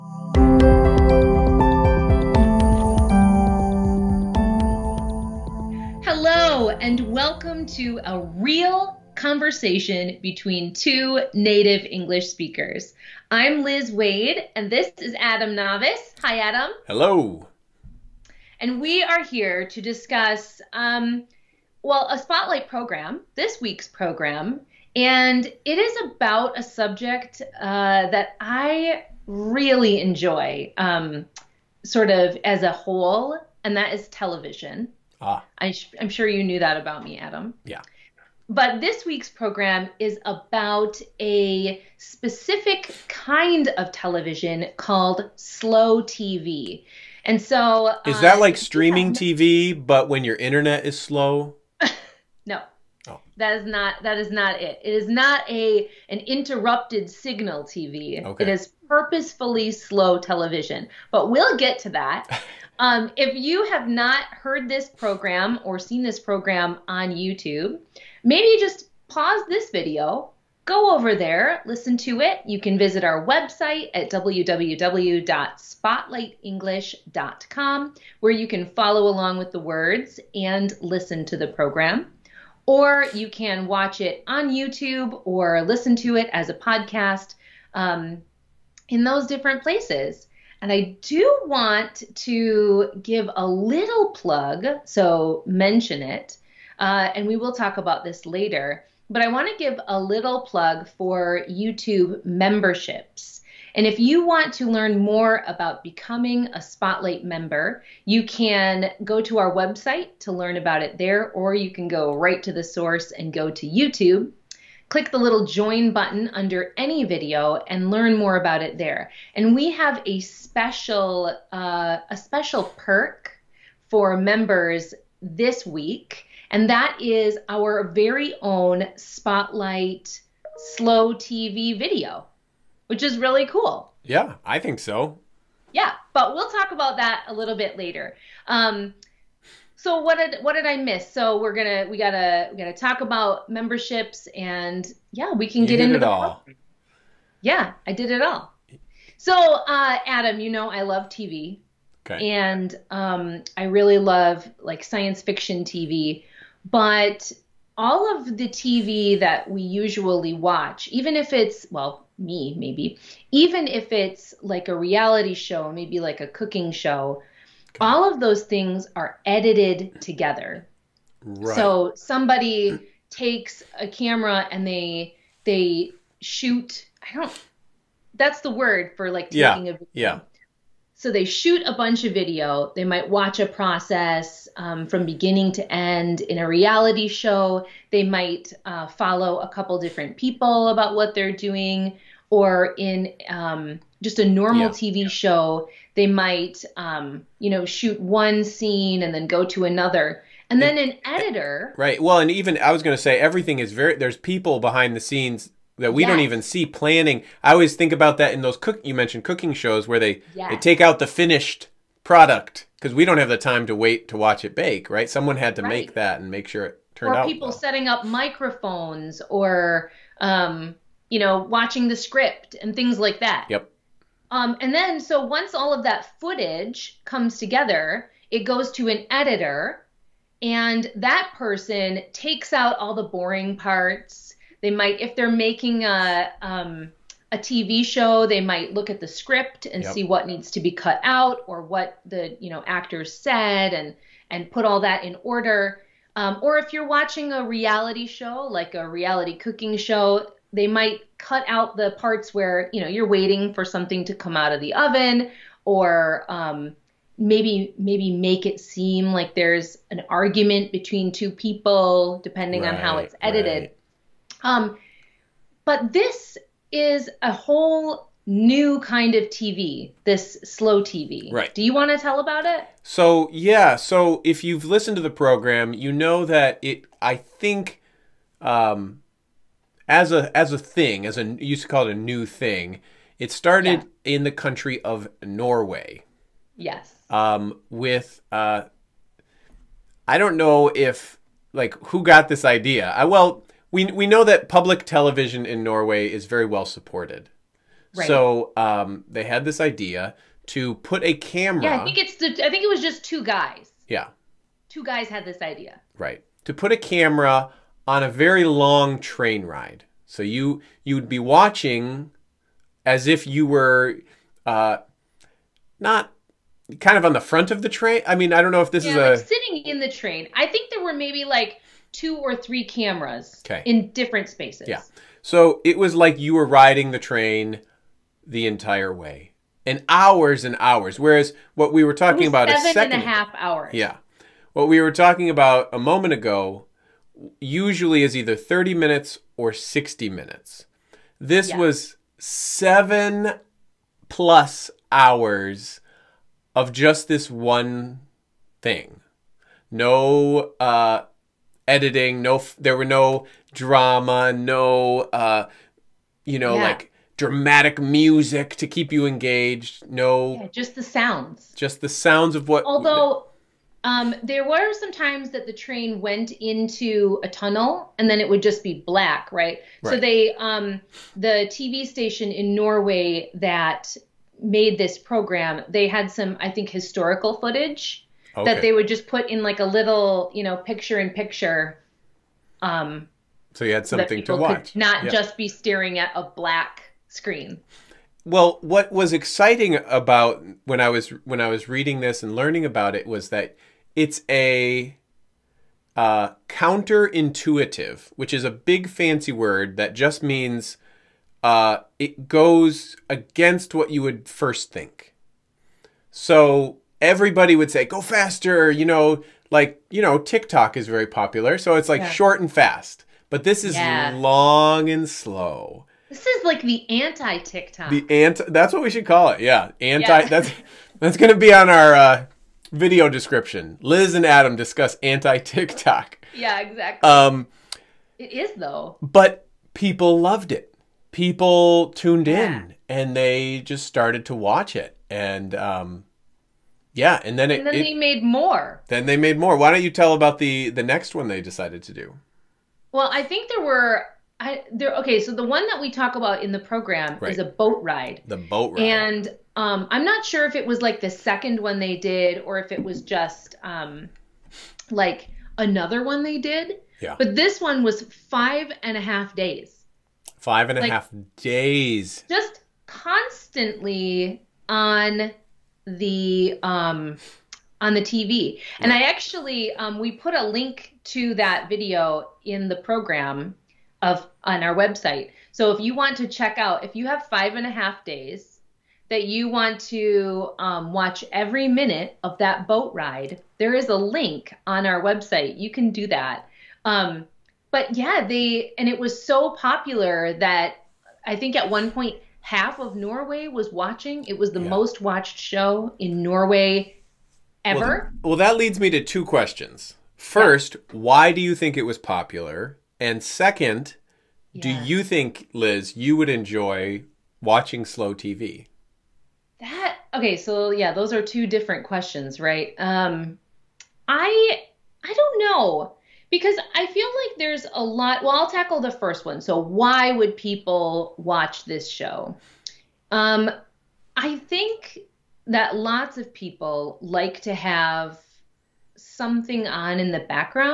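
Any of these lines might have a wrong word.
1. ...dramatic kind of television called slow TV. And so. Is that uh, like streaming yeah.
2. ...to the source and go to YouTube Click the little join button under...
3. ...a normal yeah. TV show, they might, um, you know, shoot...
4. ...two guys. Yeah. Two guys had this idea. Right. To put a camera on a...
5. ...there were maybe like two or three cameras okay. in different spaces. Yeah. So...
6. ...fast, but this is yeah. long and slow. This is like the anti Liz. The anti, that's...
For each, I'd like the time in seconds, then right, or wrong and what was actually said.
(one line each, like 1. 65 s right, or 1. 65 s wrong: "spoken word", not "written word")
1. 41 s wrong: "specific", not "dramatic"
2. 112 s right
3. 194 s right
4. 303 s right
5. 320 s right
6. 412 s wrong: "TikTok", not "Liz".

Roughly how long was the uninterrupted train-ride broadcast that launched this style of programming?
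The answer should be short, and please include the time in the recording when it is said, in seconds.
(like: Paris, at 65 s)
7 and a half hours, at 332 s.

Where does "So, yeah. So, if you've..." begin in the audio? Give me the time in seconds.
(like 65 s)
272 s.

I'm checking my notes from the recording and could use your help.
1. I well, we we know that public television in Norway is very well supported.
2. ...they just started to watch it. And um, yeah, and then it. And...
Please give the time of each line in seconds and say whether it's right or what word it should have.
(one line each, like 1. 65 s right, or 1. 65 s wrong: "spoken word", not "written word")
1. 292 s right
2. 433 s right.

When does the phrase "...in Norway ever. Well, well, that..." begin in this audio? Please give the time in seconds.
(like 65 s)
495 s.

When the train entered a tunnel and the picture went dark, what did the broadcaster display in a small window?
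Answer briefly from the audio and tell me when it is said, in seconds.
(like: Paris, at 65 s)
historical footage, at 376 s.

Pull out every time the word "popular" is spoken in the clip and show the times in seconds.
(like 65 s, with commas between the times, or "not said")
411 s, 489 s, 501 s.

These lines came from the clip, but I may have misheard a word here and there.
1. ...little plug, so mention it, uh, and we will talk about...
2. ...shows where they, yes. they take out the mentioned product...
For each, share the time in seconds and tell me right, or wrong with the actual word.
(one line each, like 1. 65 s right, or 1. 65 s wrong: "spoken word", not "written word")
1. 93 s right
2. 209 s wrong: "finished", not "mentioned".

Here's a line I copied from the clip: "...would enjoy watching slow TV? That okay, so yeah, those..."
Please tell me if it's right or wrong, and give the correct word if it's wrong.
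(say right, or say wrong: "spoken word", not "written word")
right.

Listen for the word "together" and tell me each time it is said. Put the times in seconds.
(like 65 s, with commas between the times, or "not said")
170 s, 227 s.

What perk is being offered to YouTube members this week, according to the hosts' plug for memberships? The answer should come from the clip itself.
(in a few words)
Spotlight Slow TV video.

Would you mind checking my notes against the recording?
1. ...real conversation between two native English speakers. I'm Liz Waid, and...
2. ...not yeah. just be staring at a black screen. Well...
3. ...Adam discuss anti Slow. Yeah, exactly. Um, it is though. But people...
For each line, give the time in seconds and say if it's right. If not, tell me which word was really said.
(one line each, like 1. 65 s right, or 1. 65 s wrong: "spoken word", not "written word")
1. 8 s right
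2. 384 s right
3. 424 s wrong: "TikTok", not "Slow".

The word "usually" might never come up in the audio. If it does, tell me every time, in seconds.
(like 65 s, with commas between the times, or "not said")
159 s, 337 s.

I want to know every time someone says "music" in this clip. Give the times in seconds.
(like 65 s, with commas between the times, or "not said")
357 s.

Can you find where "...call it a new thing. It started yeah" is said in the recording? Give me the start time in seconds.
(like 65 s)
281 s.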